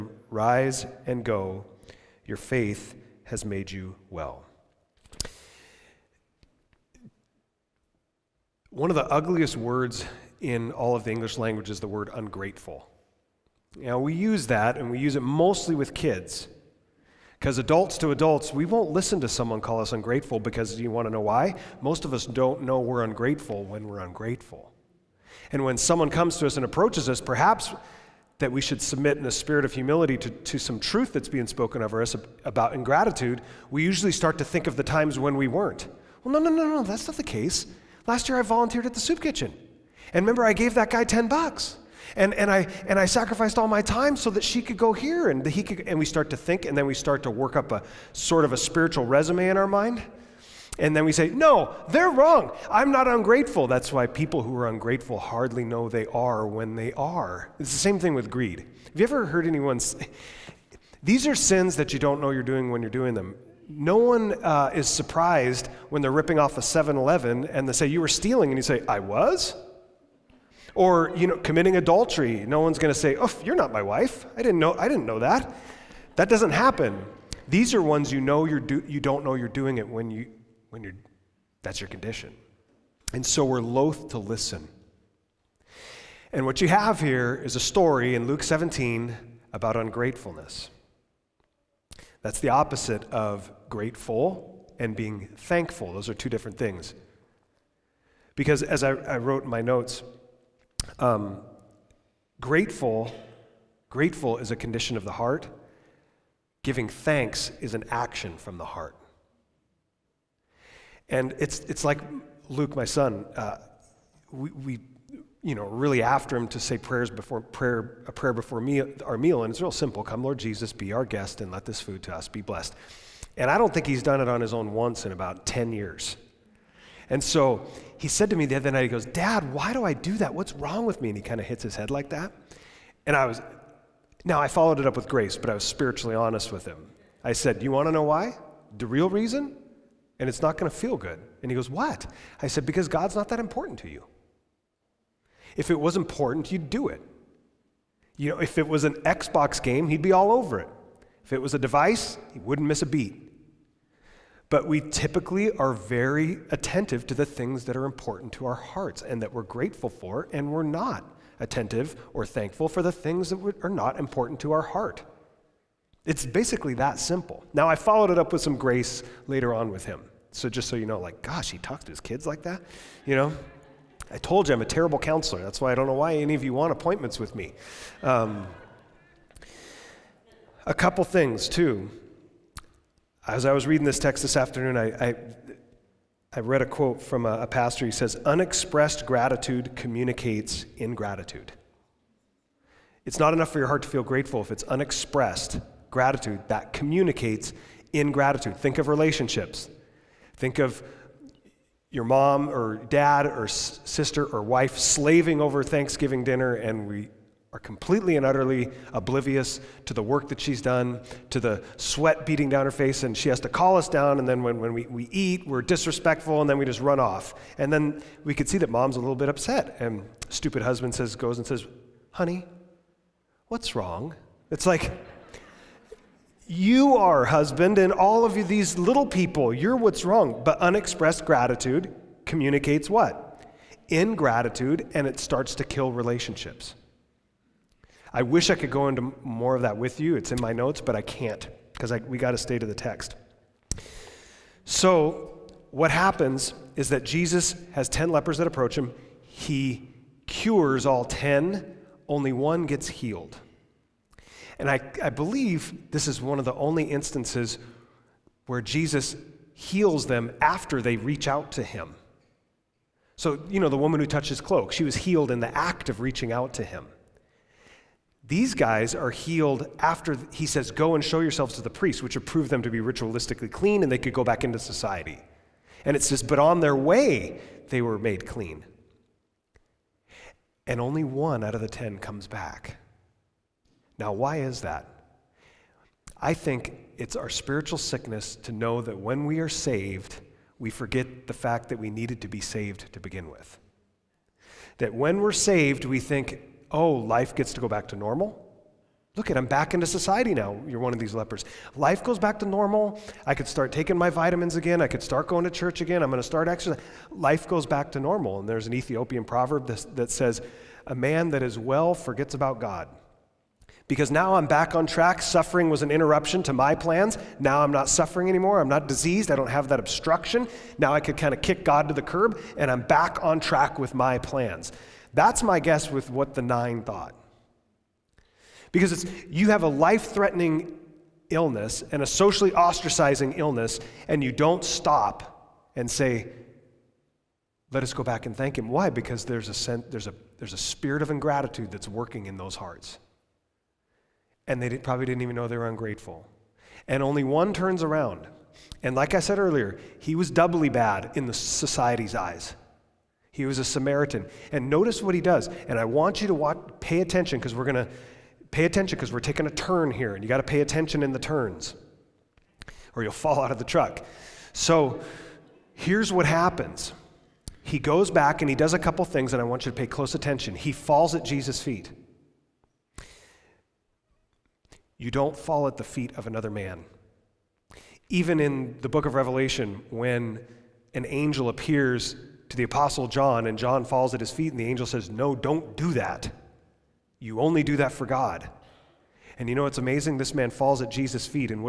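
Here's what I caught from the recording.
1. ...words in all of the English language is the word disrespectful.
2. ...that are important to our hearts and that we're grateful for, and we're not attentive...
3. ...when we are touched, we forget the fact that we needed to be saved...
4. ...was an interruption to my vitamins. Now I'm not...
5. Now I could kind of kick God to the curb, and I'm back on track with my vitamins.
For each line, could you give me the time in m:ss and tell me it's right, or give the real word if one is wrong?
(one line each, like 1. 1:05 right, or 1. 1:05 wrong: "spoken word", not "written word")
1. 0:09 wrong: "ungrateful", not "disrespectful"
2. 2:37 right
3. 4:48 wrong: "saved", not "touched"
4. 5:15 wrong: "plans", not "vitamins"
5. 5:20 wrong: "plans", not "vitamins".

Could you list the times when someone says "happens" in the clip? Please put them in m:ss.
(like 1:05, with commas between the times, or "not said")
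1:16, 4:05, 6:06.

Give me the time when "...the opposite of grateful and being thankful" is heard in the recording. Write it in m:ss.
1:32.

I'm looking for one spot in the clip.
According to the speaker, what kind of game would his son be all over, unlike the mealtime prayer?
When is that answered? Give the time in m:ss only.
2:29.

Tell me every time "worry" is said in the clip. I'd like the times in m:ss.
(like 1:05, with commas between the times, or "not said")
not said.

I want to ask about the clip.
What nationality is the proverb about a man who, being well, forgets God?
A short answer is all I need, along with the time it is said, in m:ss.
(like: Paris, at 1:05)
Ethiopian, at 5:08.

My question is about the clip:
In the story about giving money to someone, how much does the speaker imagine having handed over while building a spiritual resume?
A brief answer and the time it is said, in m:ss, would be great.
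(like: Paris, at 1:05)
10 bucks, at 0:41.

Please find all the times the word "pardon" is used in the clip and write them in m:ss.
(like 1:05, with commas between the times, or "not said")
not said.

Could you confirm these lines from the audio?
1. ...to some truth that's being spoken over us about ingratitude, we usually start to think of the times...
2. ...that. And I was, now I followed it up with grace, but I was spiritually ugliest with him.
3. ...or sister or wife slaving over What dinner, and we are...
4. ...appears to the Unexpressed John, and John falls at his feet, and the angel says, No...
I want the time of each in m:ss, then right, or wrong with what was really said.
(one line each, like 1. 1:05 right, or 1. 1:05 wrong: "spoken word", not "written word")
1. 0:30 right
2. 2:12 wrong: "honest", not "ugliest"
3. 3:23 wrong: "Thanksgiving", not "What"
4. 6:21 wrong: "Apostle", not "Unexpressed".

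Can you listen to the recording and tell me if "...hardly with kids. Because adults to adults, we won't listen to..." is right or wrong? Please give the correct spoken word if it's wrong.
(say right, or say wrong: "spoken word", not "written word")
wrong: "mostly", not "hardly".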